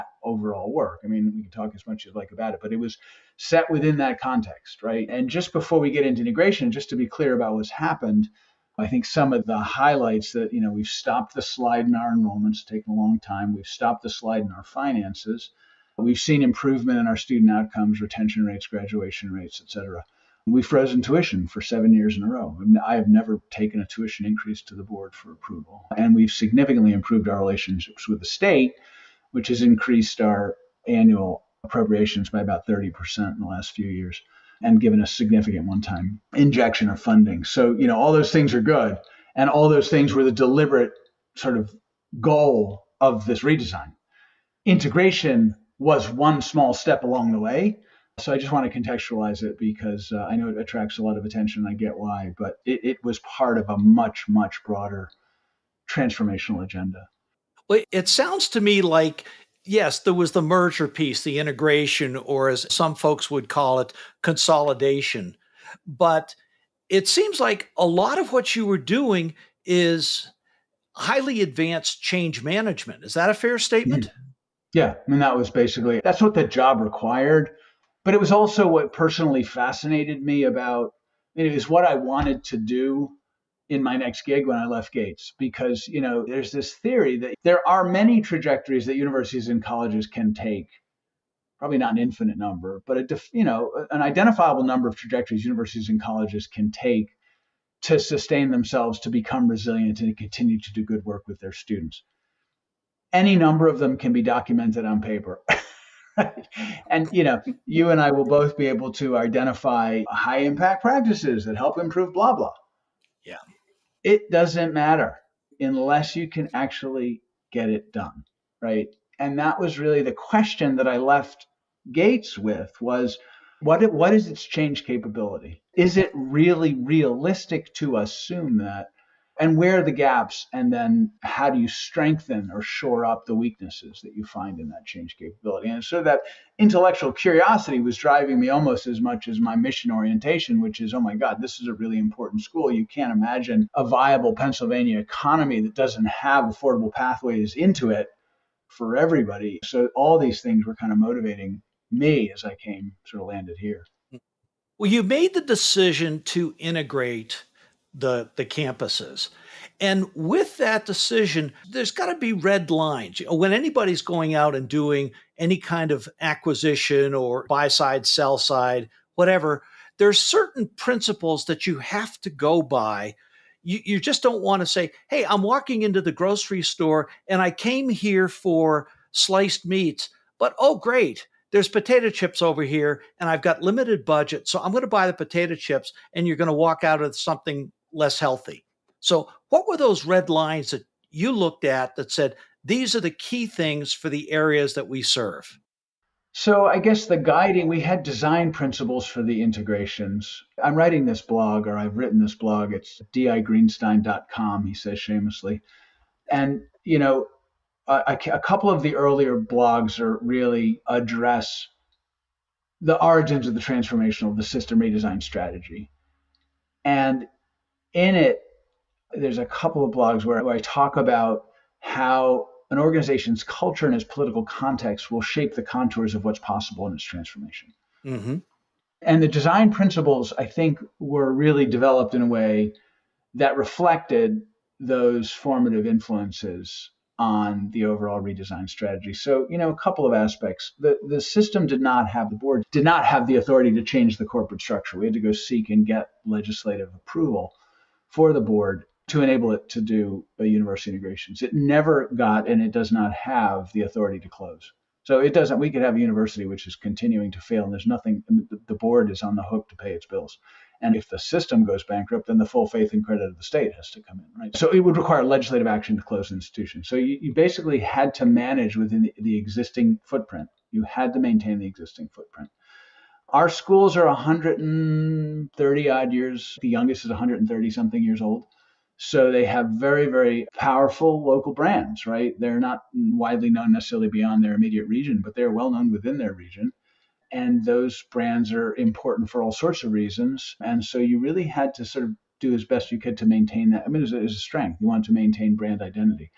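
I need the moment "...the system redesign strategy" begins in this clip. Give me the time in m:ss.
3:34.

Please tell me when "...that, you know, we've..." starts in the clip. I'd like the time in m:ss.
0:10.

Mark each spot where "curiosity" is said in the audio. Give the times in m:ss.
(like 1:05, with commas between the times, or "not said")
2:17.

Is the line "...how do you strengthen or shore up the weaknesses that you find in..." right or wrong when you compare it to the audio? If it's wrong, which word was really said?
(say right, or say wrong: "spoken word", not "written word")
right.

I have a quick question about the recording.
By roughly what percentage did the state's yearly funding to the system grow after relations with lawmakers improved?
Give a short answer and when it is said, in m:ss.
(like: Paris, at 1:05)
30%, at 0:32.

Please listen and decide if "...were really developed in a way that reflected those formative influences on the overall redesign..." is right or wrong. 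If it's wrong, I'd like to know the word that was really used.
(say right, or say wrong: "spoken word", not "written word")
right.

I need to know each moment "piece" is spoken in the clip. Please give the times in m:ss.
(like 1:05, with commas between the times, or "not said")
1:00.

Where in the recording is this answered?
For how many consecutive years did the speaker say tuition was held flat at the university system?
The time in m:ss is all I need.
0:21.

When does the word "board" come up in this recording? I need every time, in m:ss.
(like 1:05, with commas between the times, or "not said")
0:24, 4:02, 4:08, 4:18.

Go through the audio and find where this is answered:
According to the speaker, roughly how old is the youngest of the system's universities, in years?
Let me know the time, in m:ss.
4:37.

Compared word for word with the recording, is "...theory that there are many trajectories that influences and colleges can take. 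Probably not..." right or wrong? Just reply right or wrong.
wrong.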